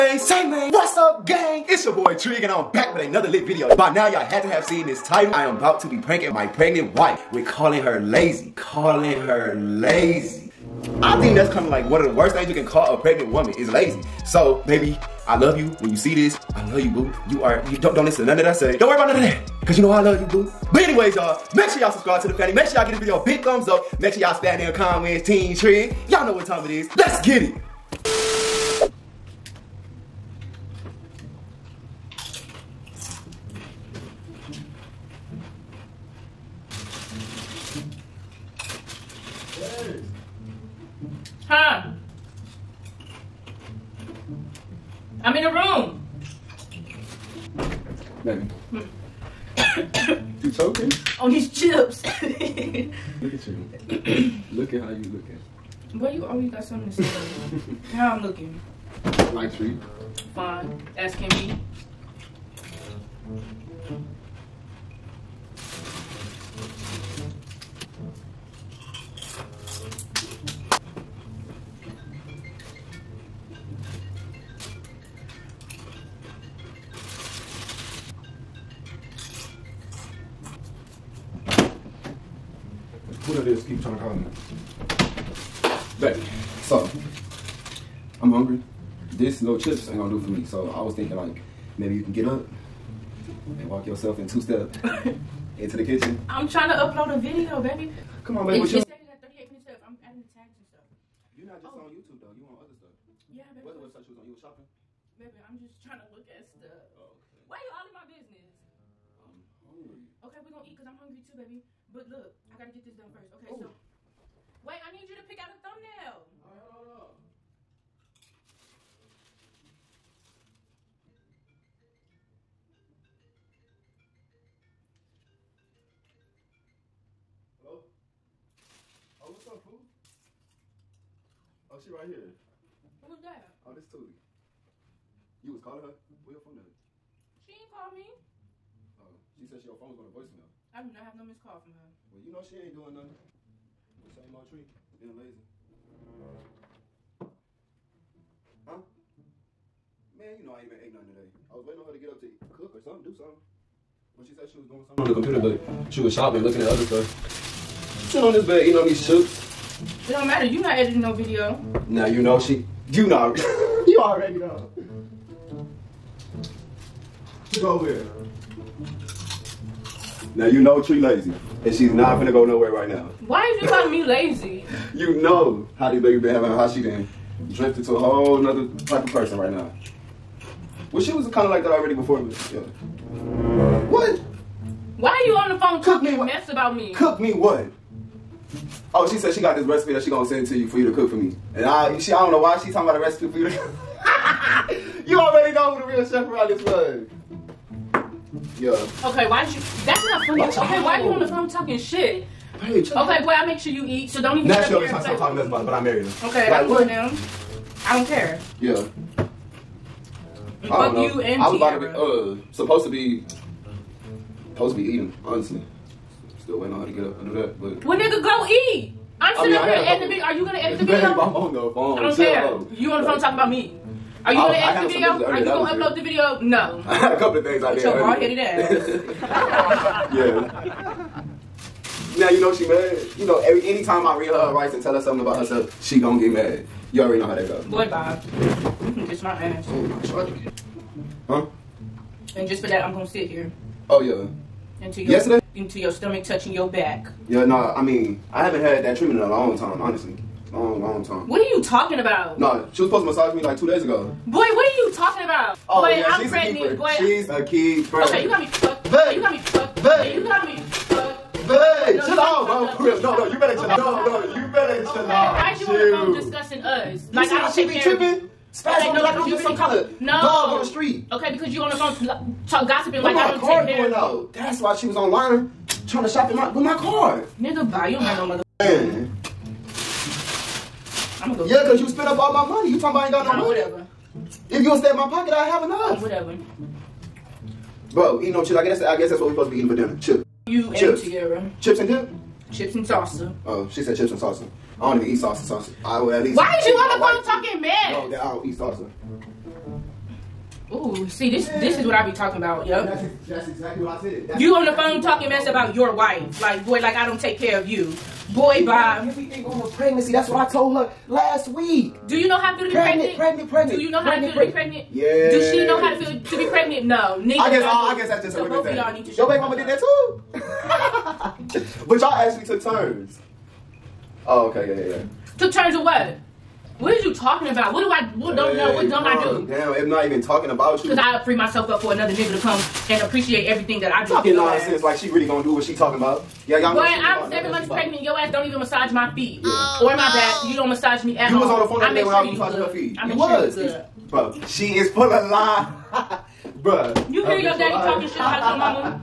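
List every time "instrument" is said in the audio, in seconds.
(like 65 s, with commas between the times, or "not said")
not said.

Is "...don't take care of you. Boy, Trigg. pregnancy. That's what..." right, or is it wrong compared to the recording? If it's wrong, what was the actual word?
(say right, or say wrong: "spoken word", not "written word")
wrong: "Bob", not "Trigg".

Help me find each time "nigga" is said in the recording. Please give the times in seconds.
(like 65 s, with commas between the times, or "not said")
217 s, 277 s, 332 s.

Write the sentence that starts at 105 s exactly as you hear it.
Baby, I'm just trying to look at stuff.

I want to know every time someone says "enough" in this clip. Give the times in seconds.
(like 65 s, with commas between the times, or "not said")
285 s.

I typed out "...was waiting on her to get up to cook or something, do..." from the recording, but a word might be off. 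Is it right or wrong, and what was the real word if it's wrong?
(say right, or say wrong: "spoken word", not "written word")
right.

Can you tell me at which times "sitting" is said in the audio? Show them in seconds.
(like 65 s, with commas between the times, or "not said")
158 s, 219 s.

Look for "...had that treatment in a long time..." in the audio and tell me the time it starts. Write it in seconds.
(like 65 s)
248 s.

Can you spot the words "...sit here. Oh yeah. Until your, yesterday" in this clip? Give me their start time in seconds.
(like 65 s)
243 s.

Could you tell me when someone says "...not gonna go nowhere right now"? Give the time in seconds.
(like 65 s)
171 s.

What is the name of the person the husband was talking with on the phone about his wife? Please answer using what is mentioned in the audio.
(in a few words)
Tootie.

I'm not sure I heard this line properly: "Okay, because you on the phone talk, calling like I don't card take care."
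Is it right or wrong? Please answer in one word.
wrong.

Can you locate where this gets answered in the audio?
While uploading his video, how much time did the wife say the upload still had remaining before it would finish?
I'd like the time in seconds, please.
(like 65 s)
99 s.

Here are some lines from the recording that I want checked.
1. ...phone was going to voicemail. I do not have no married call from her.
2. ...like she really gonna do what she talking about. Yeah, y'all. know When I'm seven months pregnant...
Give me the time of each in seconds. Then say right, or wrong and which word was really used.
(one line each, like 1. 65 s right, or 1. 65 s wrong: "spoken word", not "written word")
1. 139 s wrong: "missed", not "married"
2. 334 s right.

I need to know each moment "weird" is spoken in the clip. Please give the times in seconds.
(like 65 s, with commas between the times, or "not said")
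225 s.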